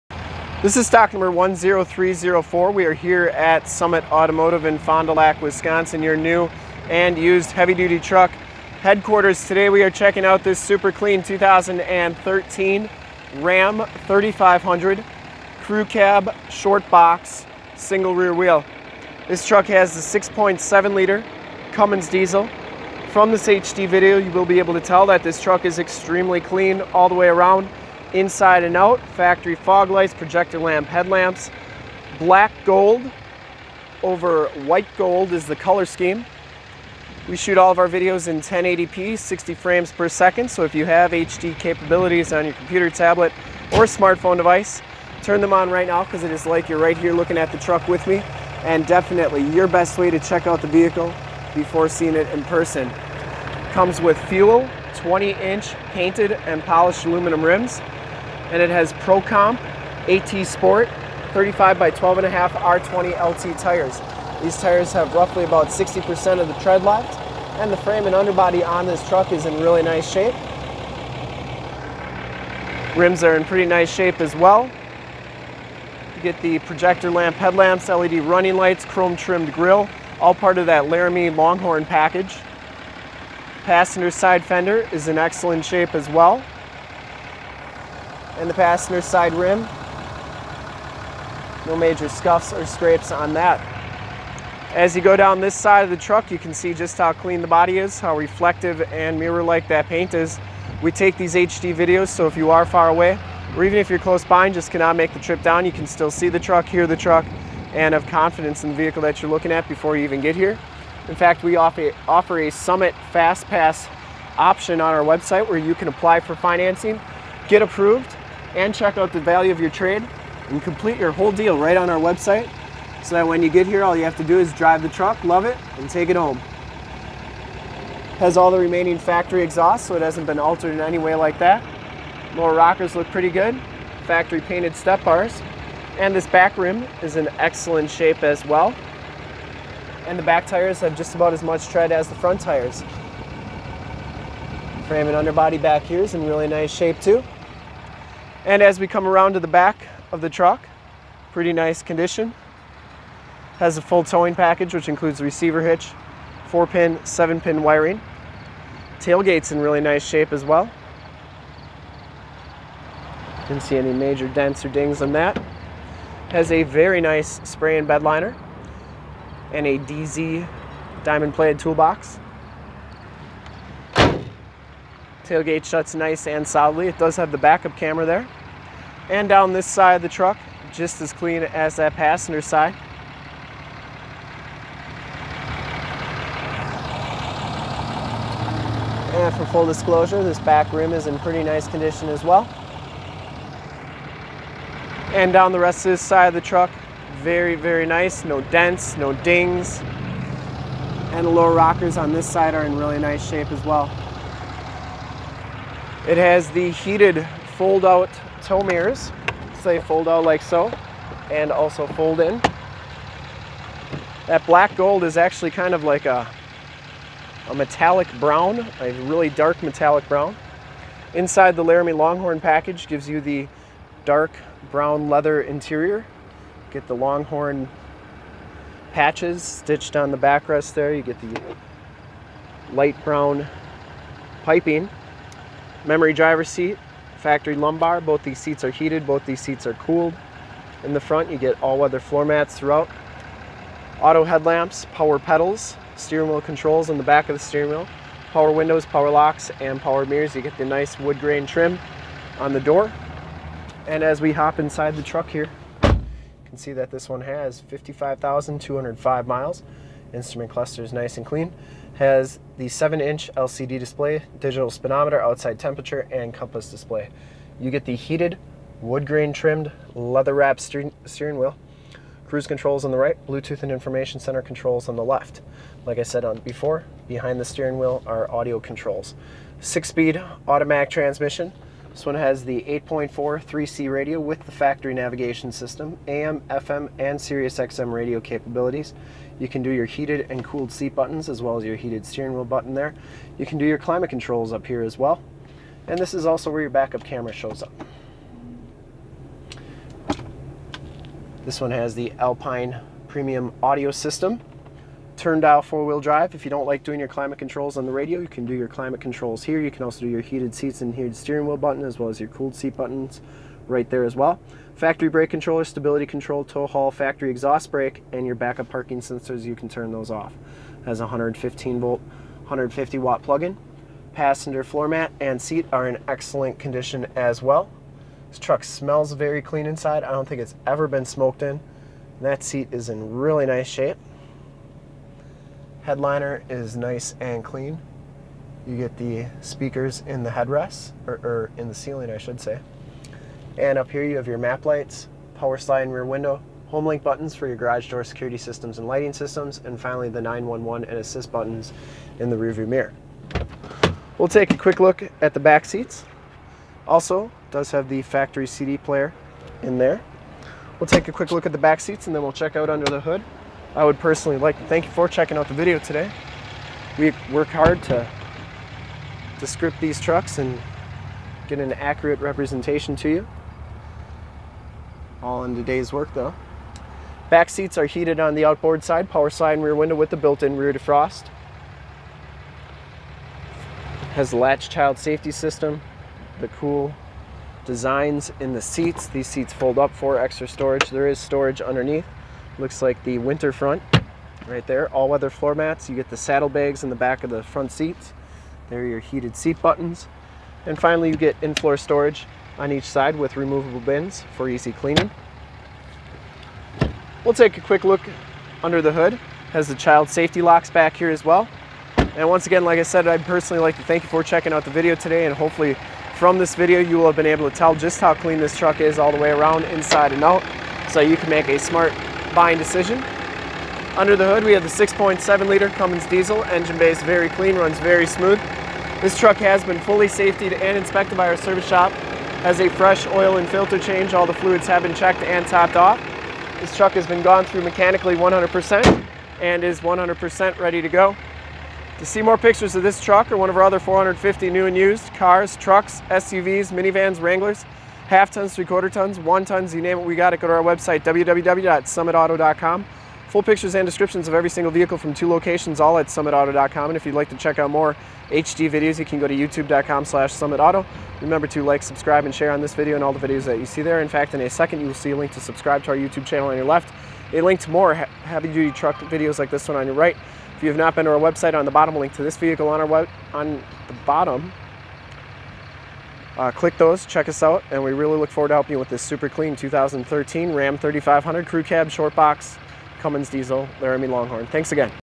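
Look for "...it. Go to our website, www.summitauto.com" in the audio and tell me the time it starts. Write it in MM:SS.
07:30.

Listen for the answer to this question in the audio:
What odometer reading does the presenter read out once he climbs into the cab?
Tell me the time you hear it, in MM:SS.
04:17.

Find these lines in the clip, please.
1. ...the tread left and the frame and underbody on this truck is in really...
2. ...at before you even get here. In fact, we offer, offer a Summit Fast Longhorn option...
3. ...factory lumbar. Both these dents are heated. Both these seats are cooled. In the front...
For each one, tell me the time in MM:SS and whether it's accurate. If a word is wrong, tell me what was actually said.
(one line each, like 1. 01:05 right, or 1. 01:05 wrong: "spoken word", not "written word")
1. 01:06 right
2. 01:49 wrong: "Pass", not "Longhorn"
3. 03:57 wrong: "seats", not "dents".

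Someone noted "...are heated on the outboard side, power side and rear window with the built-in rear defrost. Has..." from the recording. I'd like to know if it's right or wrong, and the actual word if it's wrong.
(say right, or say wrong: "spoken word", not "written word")
right.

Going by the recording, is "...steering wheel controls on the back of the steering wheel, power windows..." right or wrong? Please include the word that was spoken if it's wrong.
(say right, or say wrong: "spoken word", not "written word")
right.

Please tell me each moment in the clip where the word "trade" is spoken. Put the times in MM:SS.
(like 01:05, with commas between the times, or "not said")
01:59.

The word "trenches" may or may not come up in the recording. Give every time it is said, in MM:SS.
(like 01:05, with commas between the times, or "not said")
not said.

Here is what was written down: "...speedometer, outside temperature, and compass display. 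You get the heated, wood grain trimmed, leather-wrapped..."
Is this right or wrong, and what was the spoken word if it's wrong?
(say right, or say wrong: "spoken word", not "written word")
right.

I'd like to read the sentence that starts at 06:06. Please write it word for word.
We work hard to, to script these trucks and get an accurate representation to you.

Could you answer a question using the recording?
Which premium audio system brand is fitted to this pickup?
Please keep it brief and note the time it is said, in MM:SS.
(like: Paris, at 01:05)
Alpine, at 05:02.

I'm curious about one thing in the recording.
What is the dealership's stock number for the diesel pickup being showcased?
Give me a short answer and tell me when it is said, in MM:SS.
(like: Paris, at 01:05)
10304, at 00:01.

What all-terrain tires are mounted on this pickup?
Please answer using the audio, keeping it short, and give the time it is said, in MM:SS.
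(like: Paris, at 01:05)
Pro Comp AT Sport, at 00:58.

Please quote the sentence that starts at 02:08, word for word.
Has all the remaining factory exhaust so it hasn't been altered in any way like that.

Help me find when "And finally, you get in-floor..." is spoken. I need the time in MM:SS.
06:40.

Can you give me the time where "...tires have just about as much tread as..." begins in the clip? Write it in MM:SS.
02:20.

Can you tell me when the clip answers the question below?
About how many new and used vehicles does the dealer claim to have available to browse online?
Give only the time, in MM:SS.
07:23.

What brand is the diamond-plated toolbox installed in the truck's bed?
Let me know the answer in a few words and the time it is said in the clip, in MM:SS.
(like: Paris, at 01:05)
DeeZee, at 02:49.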